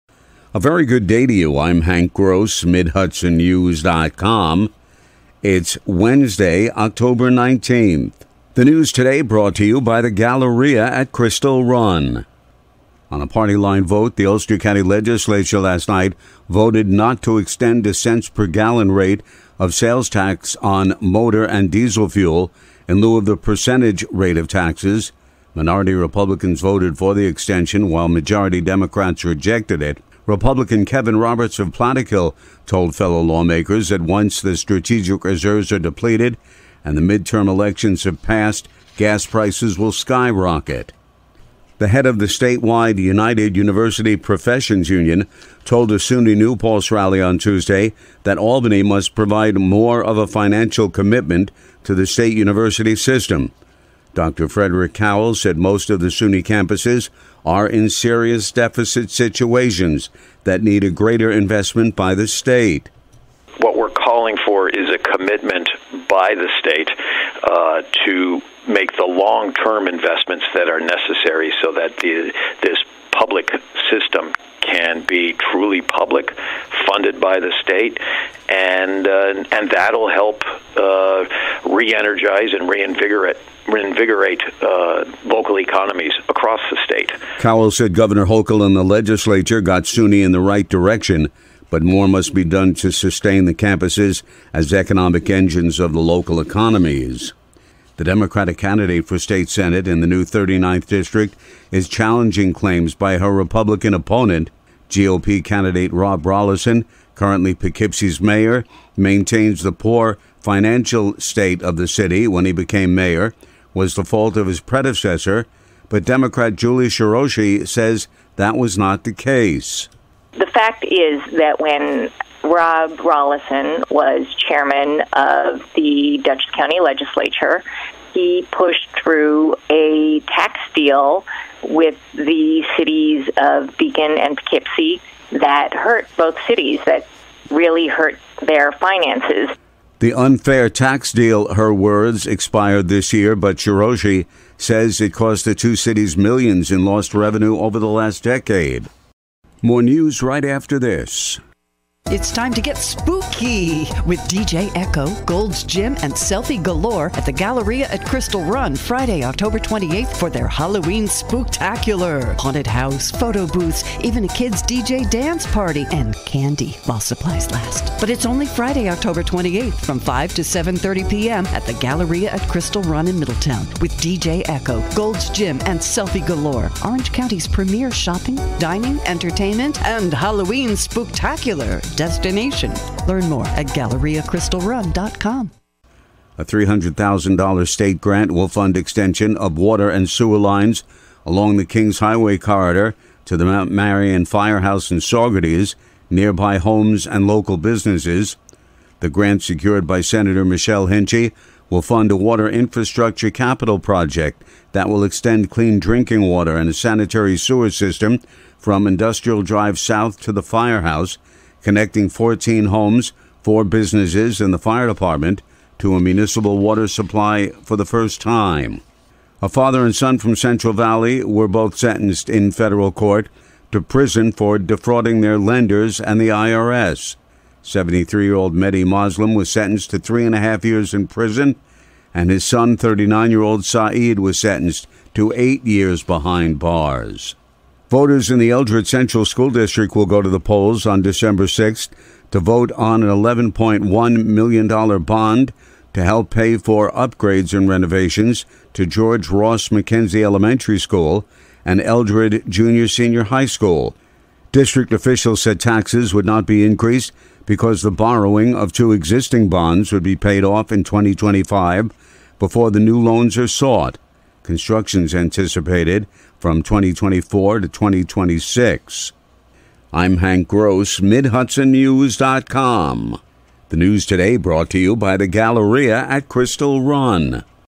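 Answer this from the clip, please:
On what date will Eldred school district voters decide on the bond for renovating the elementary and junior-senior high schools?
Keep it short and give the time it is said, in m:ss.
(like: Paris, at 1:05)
December 6th, at 4:01.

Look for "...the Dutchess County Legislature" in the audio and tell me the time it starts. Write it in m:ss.
2:05.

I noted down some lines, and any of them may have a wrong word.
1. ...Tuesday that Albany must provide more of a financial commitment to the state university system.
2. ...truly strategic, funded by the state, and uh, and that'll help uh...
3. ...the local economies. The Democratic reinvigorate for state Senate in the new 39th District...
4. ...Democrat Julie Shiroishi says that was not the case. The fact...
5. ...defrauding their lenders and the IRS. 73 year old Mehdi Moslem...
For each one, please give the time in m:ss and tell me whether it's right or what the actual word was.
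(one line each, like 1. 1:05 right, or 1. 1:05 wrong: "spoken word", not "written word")
1. 0:47 right
2. 1:15 wrong: "public", not "strategic"
3. 1:35 wrong: "candidate", not "reinvigorate"
4. 1:56 right
5. 3:44 right.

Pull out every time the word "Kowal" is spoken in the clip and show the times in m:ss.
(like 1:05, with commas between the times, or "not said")
0:54, 1:27.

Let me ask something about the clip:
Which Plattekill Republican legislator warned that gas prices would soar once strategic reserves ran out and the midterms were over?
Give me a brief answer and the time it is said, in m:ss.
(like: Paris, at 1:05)
Kevin Roberts, at 0:30.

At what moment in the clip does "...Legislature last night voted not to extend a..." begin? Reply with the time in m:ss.
0:14.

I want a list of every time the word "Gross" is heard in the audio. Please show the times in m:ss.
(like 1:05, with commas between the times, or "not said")
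0:02, 4:30.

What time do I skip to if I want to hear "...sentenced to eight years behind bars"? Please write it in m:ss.
3:54.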